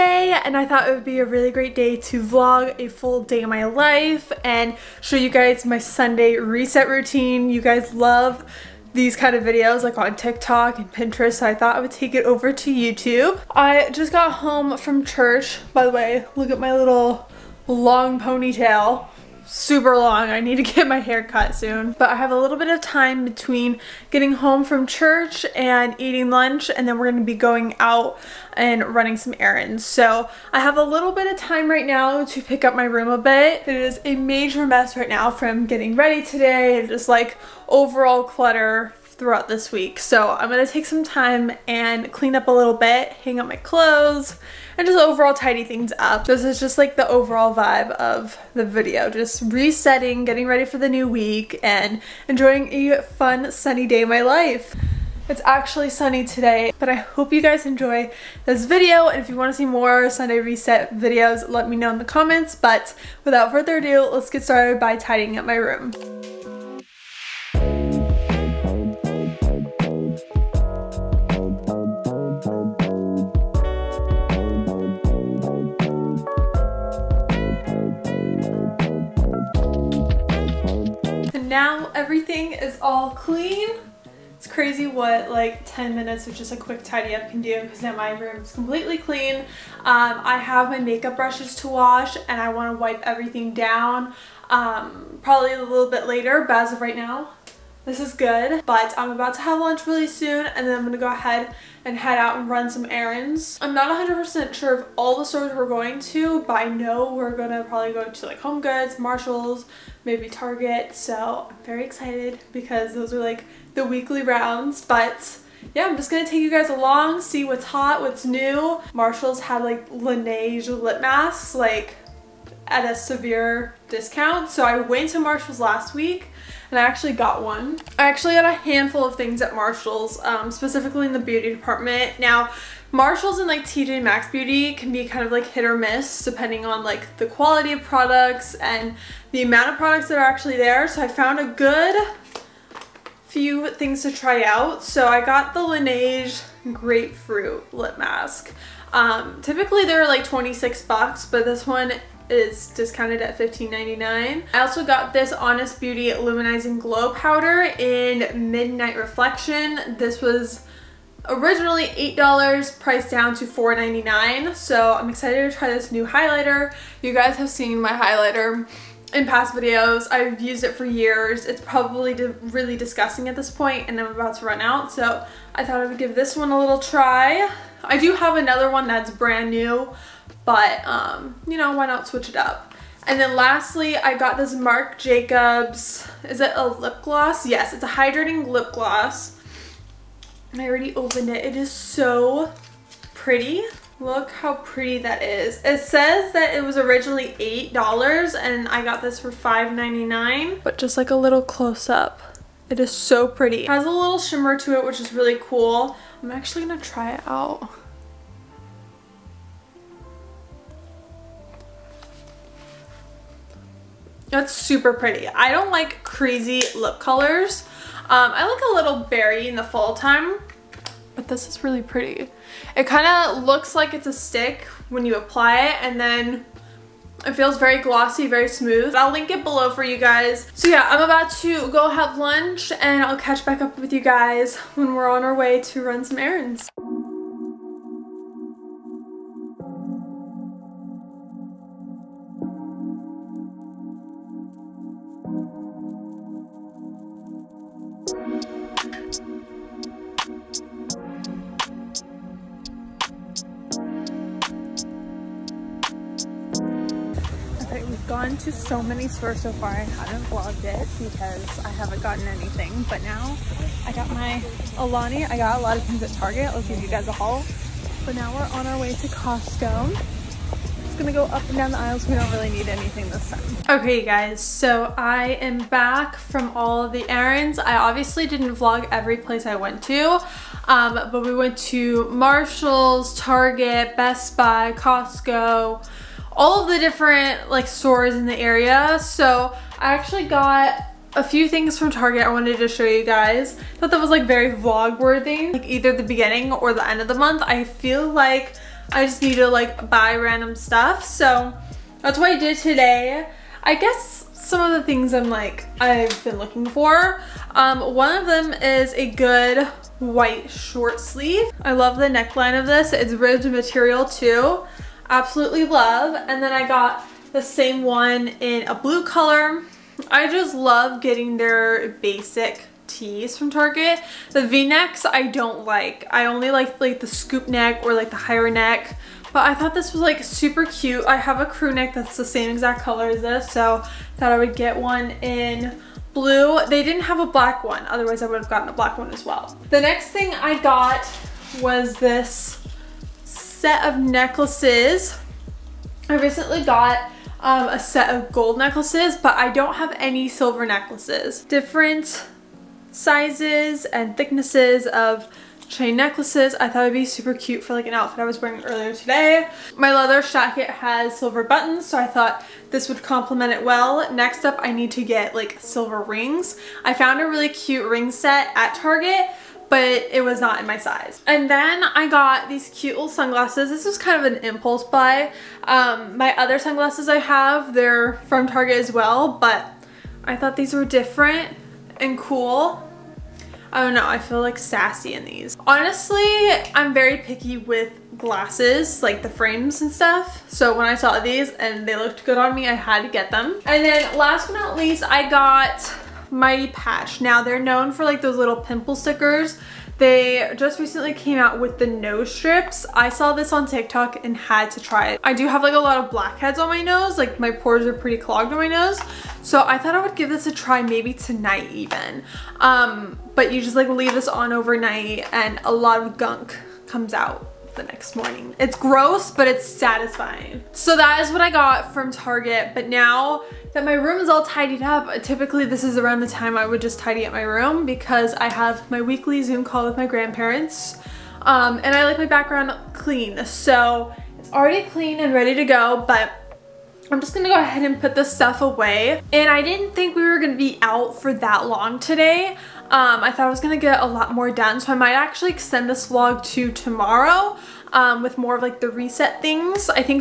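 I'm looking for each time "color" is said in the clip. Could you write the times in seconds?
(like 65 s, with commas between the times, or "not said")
216 s, 319 s, 332 s.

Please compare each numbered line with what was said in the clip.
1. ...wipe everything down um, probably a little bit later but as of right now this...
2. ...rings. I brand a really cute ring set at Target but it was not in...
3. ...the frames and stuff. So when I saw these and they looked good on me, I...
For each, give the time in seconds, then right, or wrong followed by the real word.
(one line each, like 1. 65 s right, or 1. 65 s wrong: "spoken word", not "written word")
1. 92 s right
2. 366 s wrong: "found", not "brand"
3. 389 s right.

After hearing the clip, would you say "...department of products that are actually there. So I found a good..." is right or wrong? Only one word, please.
wrong.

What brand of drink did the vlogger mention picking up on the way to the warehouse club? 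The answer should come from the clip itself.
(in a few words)
Alani.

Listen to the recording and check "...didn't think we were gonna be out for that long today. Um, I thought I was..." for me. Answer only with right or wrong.
right.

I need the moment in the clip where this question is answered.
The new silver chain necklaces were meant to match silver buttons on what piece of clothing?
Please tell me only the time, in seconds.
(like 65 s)
359 s.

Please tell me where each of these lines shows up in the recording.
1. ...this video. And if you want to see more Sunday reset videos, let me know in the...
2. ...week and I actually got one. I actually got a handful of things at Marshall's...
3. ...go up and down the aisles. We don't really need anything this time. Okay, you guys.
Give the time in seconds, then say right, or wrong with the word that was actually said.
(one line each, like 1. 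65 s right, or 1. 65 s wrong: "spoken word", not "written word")
1. 58 s right
2. 125 s right
3. 271 s right.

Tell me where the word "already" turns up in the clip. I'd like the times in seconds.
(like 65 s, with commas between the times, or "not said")
190 s, 434 s.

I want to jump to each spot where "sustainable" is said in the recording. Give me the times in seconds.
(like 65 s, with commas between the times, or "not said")
not said.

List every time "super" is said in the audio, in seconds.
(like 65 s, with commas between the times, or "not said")
19 s, 214 s, 330 s, 357 s.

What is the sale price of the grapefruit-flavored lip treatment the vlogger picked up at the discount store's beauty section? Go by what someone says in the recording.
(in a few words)
$15.99.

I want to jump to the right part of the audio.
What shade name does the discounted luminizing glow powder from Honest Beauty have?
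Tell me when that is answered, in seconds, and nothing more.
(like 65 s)
158 s.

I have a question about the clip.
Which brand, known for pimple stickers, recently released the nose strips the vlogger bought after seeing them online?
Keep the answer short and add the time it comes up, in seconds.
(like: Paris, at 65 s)
Mighty Patch, at 396 s.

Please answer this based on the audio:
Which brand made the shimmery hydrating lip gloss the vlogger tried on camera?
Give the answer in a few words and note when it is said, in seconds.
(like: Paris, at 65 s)
Marc Jacobs, at 184 s.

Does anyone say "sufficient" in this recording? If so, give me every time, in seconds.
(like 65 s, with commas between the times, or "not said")
not said.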